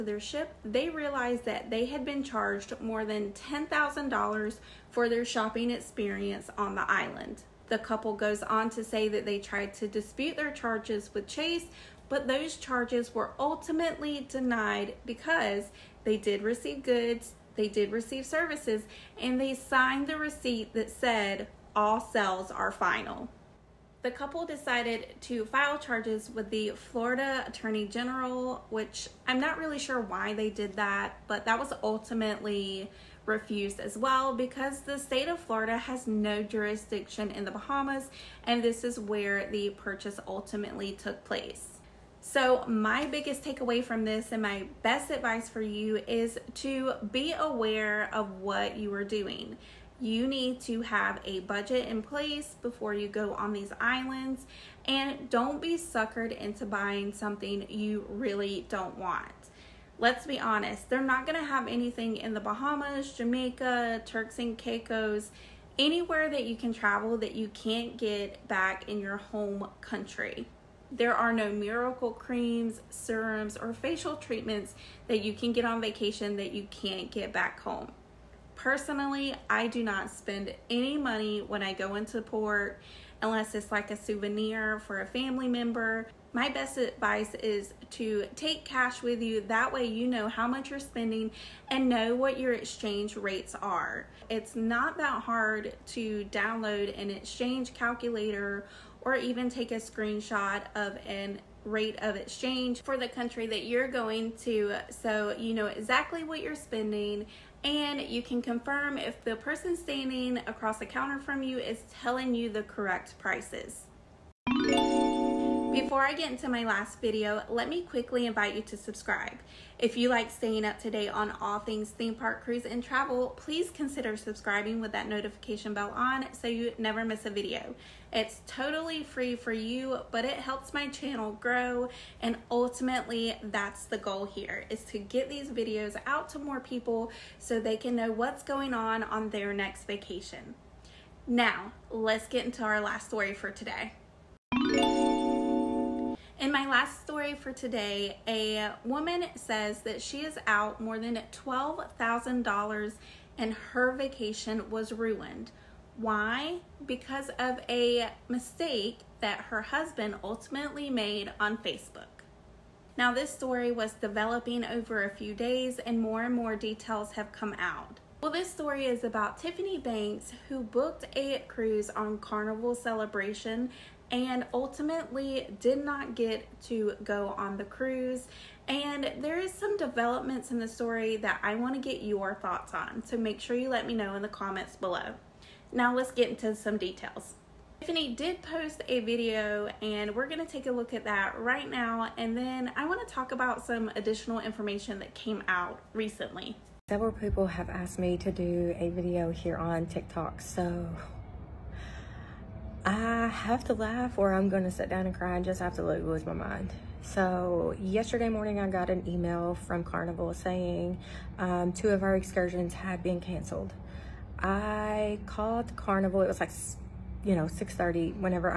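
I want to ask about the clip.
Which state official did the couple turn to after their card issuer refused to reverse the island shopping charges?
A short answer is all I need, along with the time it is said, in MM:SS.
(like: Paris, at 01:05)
Florida Attorney General, at 00:26.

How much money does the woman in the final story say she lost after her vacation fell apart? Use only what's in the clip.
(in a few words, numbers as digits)
$12,000.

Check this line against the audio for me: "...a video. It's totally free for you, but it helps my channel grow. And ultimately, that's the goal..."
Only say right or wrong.
right.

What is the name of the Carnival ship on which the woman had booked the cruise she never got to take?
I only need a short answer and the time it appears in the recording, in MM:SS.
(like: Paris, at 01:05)
Carnival Celebration, at 02:52.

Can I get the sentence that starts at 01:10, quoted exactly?
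There are no miracle creams, serums, or facial treatments that you can get on vacation that you can't get back home.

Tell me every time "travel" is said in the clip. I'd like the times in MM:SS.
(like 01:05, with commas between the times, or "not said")
01:06, 02:02.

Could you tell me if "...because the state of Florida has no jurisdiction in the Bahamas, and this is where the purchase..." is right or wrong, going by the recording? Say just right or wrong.
right.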